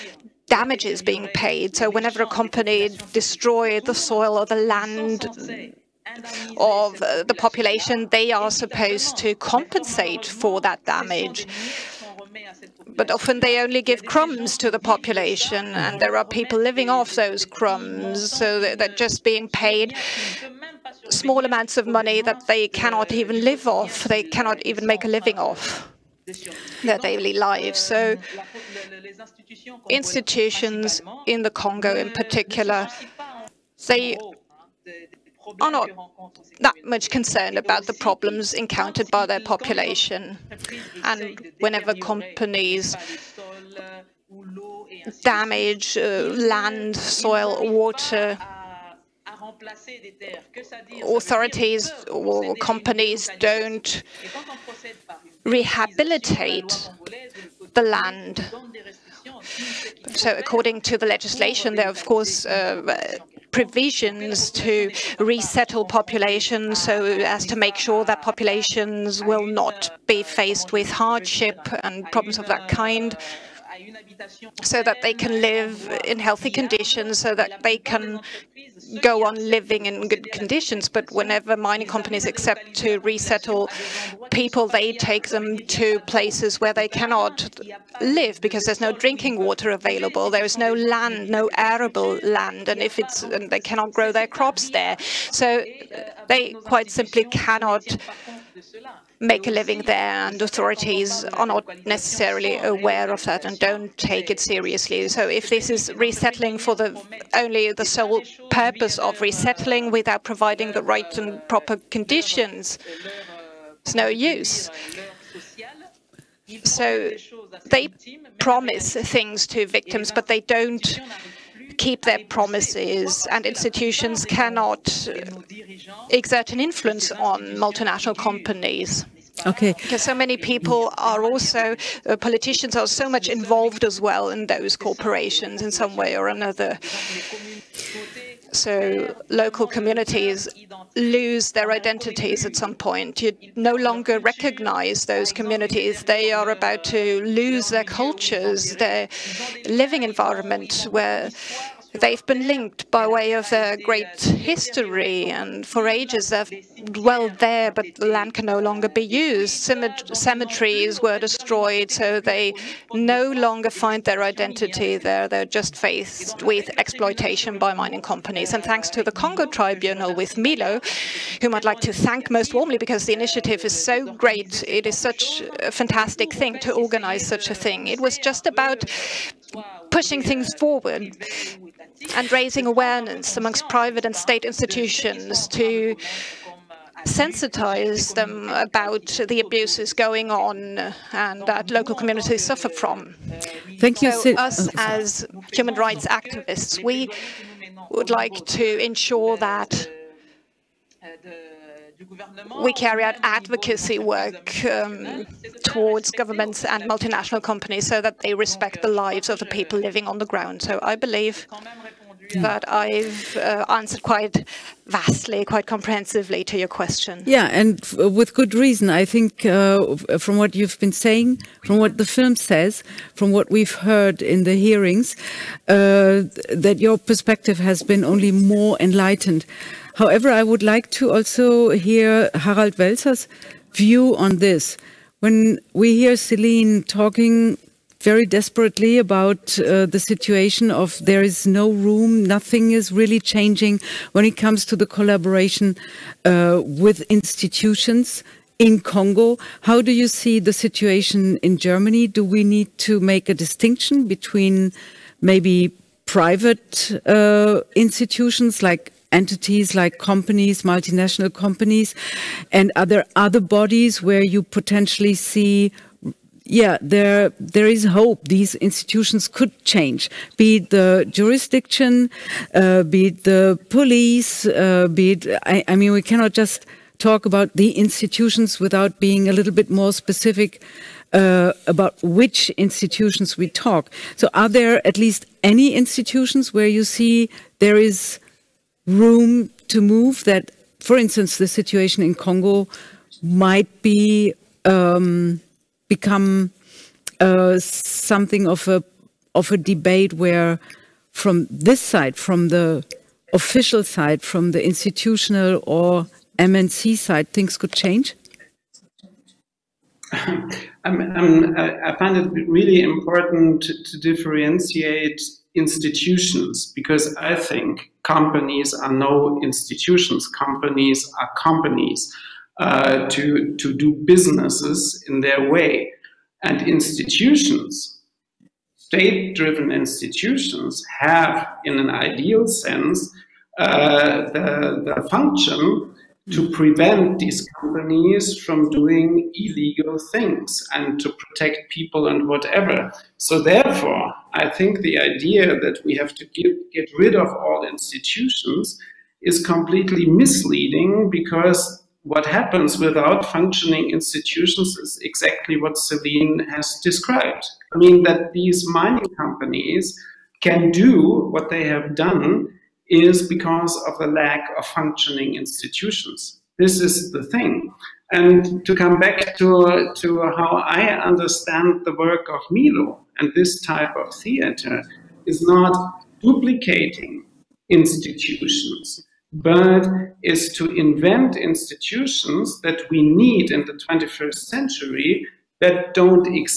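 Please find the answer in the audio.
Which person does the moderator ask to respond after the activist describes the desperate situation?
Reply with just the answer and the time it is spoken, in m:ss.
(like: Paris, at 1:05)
Harald Welzer, at 3:52.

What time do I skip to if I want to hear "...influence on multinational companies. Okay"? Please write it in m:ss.
2:06.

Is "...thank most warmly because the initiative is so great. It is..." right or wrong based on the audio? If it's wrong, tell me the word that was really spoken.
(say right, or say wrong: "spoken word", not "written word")
right.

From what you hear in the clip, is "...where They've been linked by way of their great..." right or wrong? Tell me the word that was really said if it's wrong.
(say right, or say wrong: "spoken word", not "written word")
right.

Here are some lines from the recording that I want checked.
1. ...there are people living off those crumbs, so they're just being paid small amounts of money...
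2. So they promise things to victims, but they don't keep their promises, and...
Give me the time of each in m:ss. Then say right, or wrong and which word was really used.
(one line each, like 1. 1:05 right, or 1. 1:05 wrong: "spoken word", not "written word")
1. 0:16 right
2. 1:56 right.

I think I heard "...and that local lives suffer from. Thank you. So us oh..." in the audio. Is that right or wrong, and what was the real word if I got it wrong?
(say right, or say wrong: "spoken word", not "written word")
wrong: "communities", not "lives".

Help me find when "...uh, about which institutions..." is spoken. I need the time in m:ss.
4:41.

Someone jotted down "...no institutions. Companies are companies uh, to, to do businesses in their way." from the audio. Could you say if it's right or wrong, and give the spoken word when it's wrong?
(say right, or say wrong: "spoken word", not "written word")
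right.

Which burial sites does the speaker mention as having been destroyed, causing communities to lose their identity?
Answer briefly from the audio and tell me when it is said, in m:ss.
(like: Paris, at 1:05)
cemeteries, at 2:40.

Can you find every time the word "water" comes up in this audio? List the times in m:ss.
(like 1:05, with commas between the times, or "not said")
0:47, 1:29.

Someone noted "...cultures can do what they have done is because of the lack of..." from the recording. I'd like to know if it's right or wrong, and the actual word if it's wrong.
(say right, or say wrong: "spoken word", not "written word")
wrong: "companies", not "cultures".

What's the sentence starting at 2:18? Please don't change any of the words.
So local communities lose their identities at some point.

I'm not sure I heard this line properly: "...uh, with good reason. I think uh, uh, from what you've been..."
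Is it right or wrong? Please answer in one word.
right.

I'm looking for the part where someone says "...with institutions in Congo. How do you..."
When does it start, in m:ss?
4:06.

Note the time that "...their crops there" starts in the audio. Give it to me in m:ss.
1:34.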